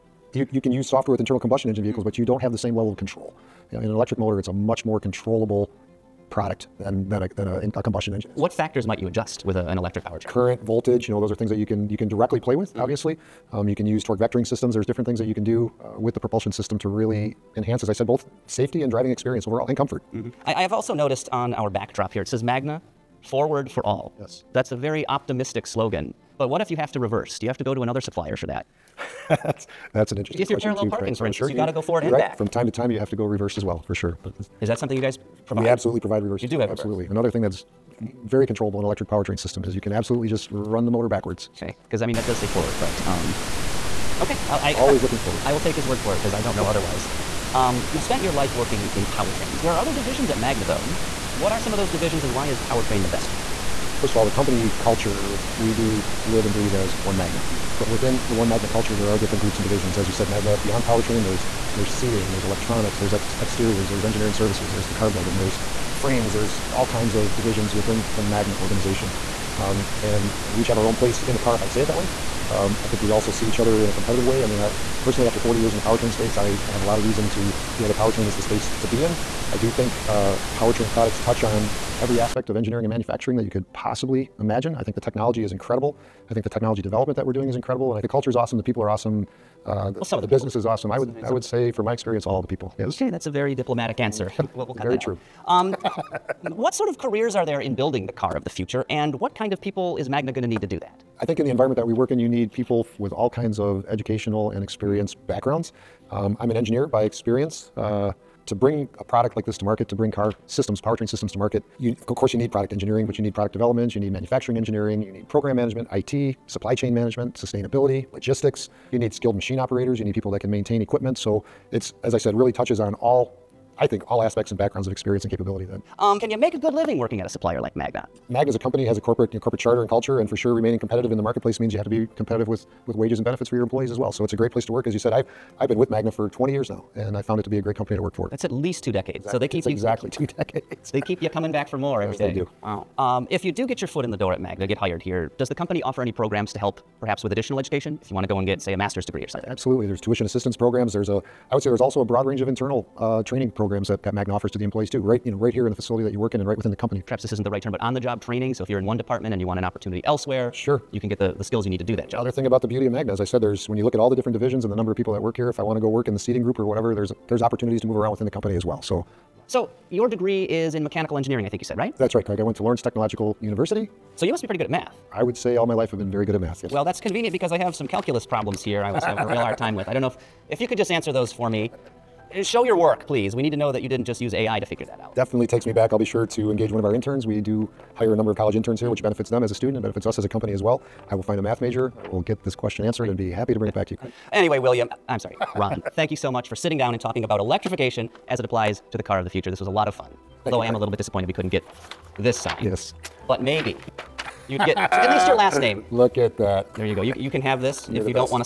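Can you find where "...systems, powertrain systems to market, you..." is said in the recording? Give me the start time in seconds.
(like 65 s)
110 s.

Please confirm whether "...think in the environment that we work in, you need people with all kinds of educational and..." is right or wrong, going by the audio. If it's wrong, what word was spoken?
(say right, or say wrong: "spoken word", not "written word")
right.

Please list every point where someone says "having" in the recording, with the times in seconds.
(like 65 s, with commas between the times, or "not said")
179 s.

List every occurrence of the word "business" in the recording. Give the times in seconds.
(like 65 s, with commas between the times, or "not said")
90 s.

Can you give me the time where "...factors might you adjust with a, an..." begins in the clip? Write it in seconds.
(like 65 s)
8 s.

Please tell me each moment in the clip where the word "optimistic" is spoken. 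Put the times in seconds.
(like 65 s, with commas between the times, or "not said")
25 s.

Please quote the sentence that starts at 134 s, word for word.
So it's a great place to work.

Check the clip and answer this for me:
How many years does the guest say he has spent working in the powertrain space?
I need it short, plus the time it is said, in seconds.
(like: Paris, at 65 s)
40, at 75 s.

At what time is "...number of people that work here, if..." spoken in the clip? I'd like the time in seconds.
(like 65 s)
164 s.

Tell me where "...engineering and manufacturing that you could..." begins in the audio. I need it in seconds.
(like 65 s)
82 s.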